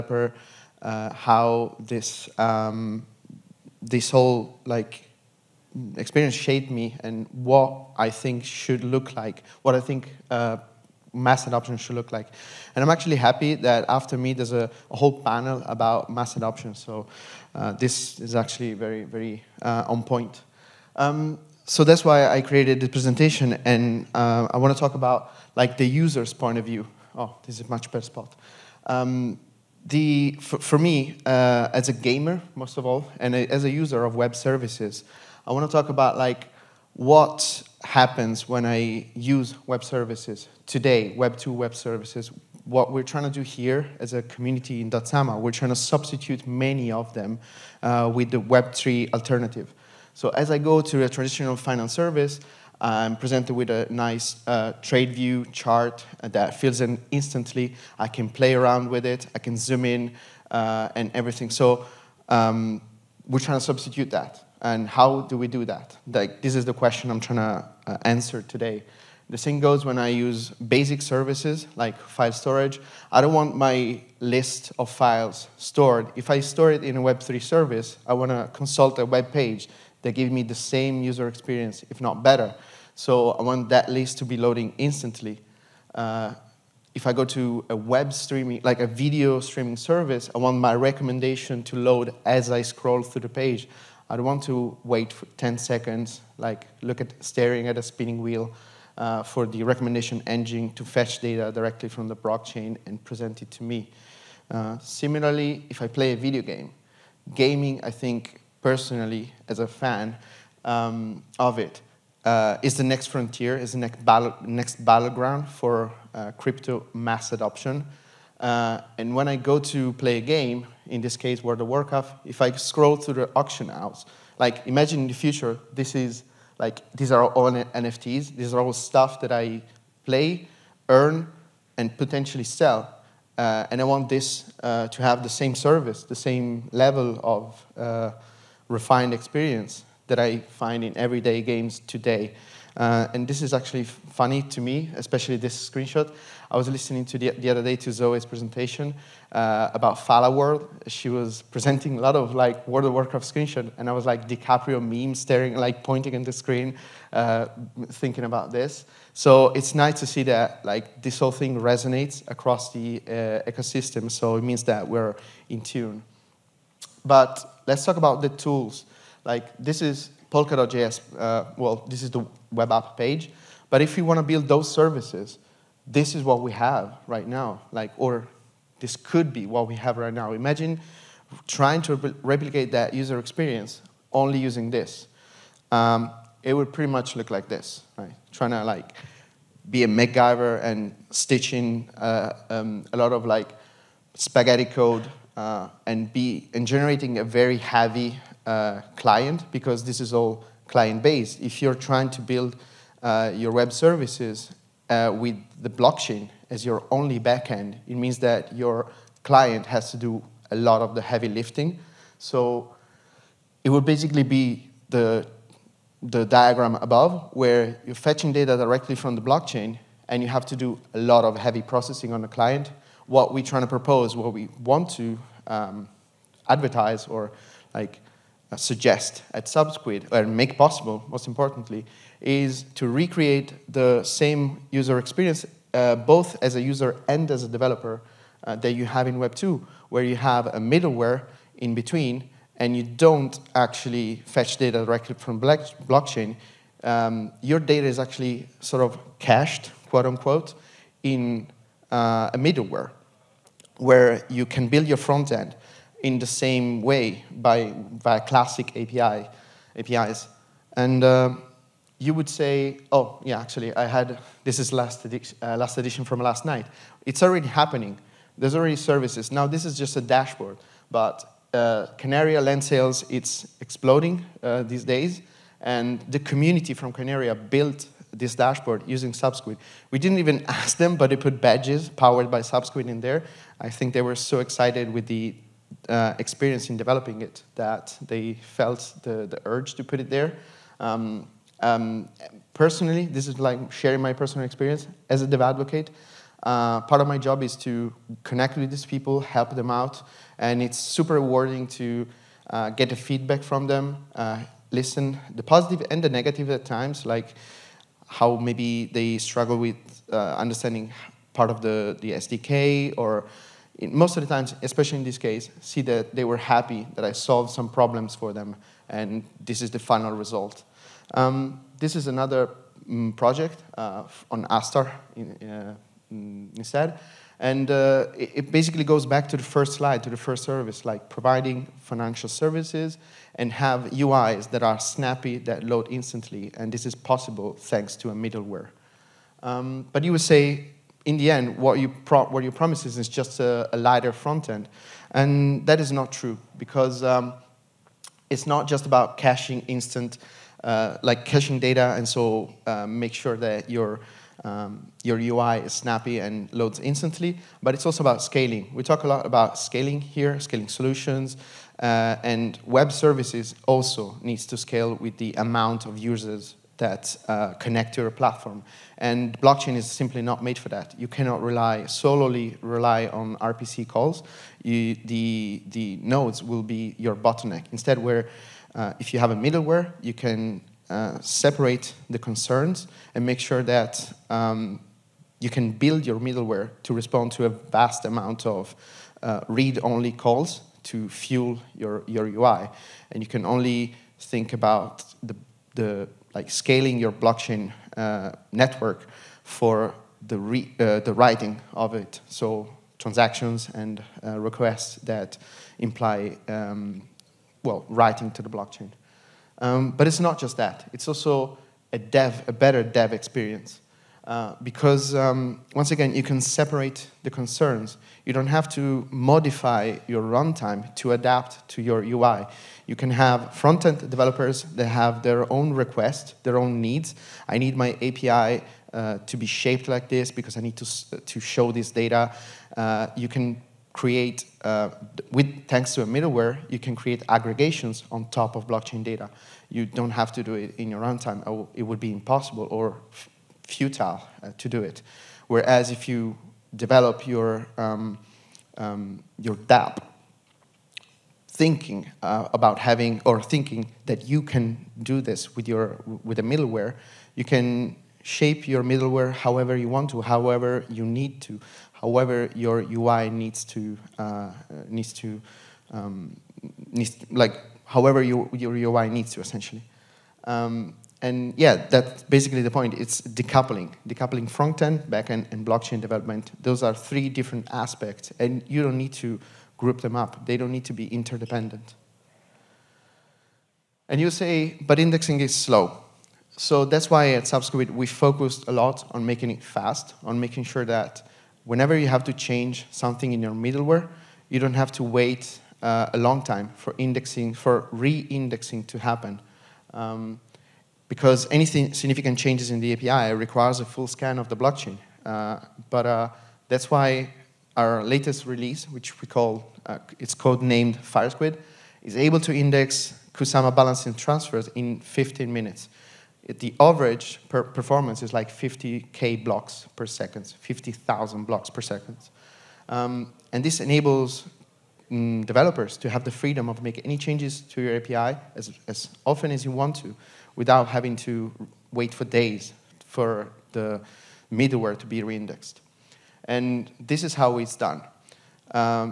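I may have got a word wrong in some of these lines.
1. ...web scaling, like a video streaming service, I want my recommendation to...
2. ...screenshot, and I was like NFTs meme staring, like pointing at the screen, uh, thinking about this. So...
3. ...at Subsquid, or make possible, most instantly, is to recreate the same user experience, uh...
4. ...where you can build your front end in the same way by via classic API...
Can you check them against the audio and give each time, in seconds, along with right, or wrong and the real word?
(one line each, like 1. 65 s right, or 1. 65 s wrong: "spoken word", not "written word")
1. 87 s wrong: "streaming", not "scaling"
2. 153 s wrong: "DiCaprio", not "NFTs"
3. 229 s wrong: "importantly", not "instantly"
4. 253 s right.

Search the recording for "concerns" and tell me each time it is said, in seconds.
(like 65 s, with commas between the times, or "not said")
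382 s, 417 s.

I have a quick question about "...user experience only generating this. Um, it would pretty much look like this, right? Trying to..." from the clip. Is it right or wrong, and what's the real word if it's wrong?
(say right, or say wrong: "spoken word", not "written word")
wrong: "using", not "generating".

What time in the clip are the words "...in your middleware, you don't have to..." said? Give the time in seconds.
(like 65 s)
493 s.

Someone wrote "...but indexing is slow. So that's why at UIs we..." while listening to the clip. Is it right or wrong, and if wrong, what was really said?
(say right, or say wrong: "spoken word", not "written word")
wrong: "Subsquid", not "UIs".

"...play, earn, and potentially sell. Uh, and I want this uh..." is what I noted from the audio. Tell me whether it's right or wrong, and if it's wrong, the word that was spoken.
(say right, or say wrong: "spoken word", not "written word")
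right.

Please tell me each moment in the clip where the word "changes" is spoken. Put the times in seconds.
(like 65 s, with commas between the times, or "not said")
492 s, 502 s, 527 s.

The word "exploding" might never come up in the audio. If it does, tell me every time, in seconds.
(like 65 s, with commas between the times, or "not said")
273 s.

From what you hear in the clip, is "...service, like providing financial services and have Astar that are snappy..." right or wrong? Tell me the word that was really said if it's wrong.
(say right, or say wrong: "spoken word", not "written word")
wrong: "UIs", not "Astar".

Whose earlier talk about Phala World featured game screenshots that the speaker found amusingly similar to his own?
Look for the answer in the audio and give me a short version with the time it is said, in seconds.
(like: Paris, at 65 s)
Zoe, at 147 s.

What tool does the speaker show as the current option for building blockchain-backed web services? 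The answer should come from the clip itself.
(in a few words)
Polkadot.js.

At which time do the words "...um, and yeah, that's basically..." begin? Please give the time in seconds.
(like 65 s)
470 s.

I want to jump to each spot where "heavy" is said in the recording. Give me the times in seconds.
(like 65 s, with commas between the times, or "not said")
197 s, 211 s, 221 s.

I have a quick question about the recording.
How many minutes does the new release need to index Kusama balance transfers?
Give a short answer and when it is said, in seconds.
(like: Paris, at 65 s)
15, at 515 s.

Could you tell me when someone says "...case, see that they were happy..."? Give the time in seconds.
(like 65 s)
315 s.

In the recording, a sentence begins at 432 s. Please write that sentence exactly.
Uh, you can create, uh, with thanks to a middleware, you can create aggregations on top of blockchain data.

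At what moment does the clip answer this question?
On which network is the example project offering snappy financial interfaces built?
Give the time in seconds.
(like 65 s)
324 s.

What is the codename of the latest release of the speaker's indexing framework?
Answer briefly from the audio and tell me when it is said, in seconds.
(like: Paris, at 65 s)
FireSquid, at 510 s.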